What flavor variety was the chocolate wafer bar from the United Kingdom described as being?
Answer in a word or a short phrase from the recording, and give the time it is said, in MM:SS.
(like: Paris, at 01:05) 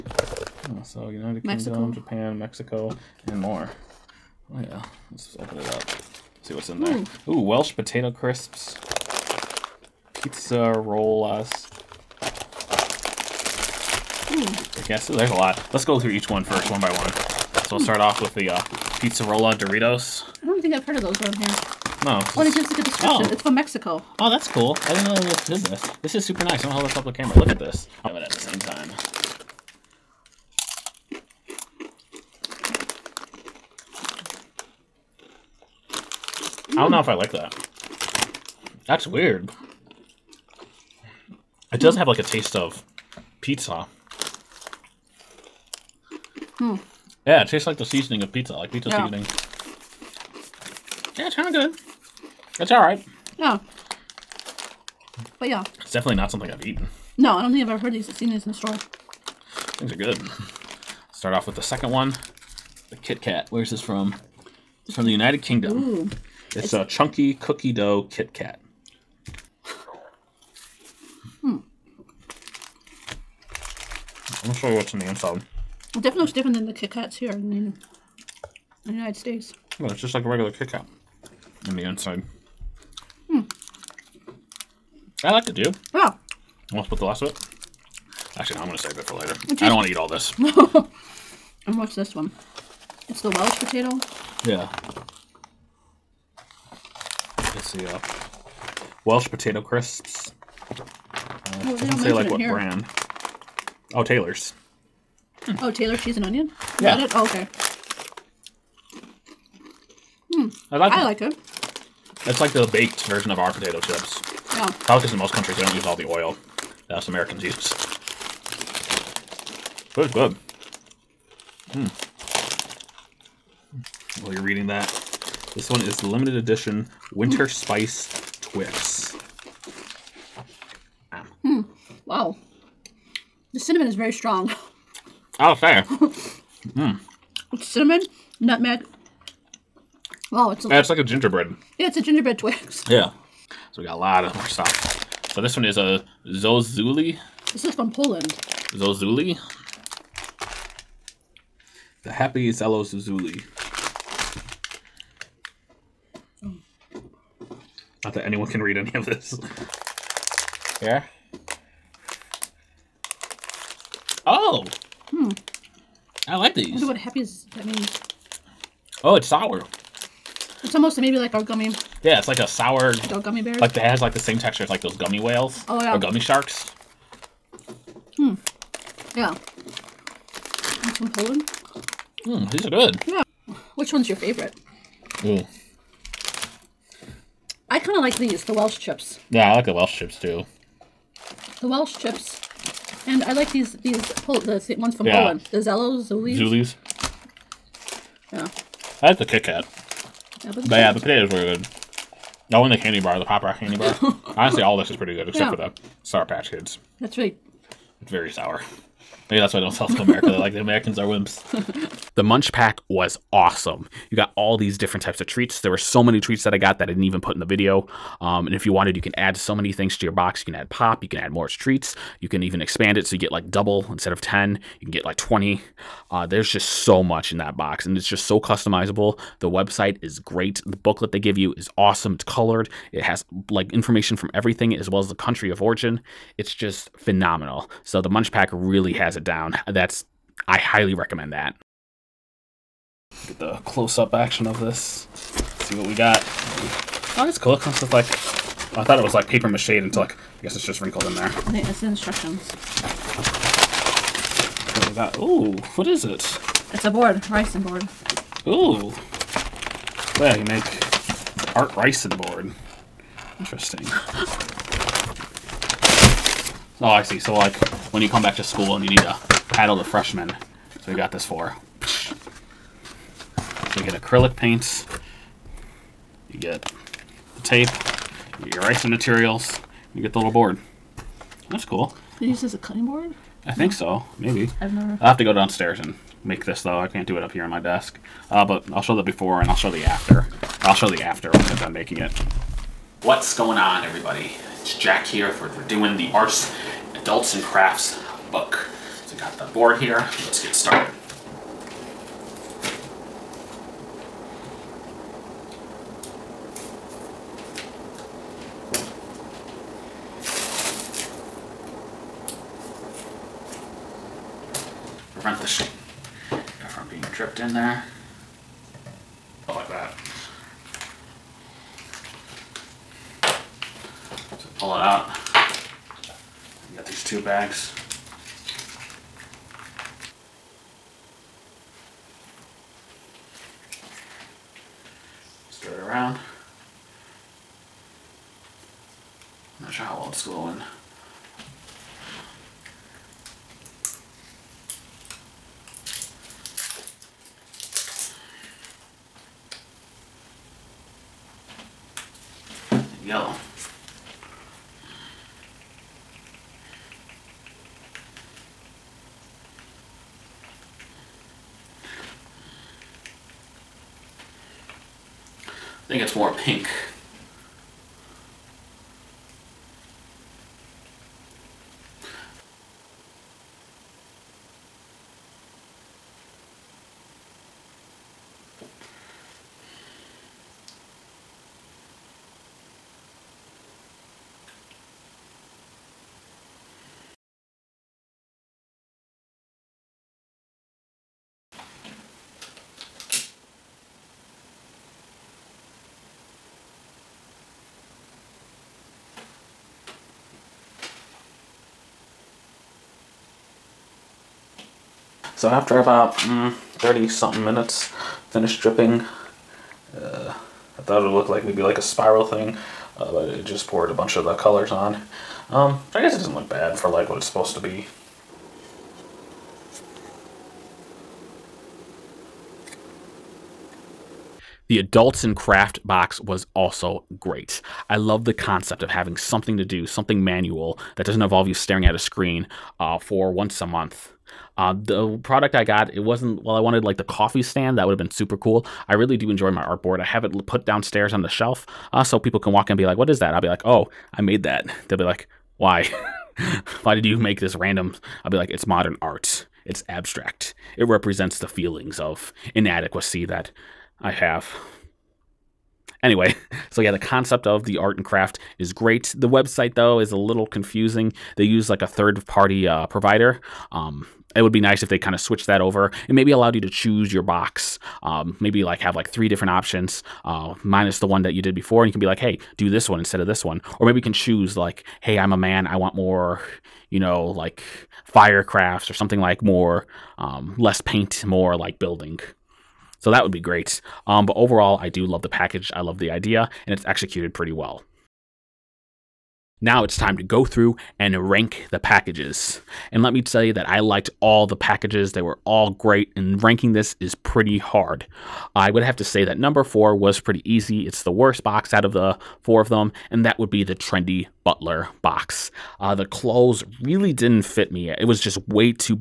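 chunky cookie dough, at 01:06.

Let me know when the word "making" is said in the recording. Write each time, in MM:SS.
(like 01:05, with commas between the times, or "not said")
04:51.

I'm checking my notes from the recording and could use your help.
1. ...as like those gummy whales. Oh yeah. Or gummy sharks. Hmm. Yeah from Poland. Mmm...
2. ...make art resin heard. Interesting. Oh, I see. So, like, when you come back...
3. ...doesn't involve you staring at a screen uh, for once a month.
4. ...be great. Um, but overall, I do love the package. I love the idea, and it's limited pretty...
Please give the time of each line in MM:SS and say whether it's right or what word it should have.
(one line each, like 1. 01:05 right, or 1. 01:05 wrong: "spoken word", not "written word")
1. 02:54 right
2. 04:20 wrong: "board", not "heard"
3. 07:11 right
4. 08:03 wrong: "executed", not "limited".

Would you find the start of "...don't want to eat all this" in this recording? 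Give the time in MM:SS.
01:29.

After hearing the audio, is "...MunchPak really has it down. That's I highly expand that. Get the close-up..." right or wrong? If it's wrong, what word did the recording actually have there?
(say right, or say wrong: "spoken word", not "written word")
wrong: "recommend", not "expand".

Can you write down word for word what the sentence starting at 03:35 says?
There were so many treats that I got that I didn't even put in the video.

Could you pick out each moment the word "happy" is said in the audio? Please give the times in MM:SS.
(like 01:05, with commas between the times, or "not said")
02:32, 02:46.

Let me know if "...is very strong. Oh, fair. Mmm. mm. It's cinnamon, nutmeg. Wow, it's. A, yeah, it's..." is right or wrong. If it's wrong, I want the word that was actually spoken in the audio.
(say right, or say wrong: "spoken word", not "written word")
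right.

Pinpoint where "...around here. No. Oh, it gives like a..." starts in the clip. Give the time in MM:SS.
00:21.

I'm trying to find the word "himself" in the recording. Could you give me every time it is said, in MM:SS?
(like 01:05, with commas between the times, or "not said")
not said.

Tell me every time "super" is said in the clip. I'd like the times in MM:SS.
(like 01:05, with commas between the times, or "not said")
00:26, 07:18.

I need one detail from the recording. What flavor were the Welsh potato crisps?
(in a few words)
cheese and onion.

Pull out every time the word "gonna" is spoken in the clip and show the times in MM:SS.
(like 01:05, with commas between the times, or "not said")
00:26, 01:14.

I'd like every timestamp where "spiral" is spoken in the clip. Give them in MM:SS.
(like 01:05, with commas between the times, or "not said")
06:51.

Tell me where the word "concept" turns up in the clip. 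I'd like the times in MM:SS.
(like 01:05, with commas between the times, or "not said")
07:08, 07:36.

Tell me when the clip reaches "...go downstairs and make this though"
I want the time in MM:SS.
04:45.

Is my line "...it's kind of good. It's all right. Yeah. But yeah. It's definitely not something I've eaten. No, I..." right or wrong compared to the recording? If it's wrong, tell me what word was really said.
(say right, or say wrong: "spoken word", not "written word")
right.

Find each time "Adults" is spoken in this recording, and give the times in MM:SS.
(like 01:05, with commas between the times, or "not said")
04:56, 07:04.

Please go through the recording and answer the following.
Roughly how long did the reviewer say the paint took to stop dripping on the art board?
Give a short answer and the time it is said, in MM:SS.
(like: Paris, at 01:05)
30 something minutes, at 06:46.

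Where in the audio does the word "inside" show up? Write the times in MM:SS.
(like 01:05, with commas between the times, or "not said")
01:15, 01:21.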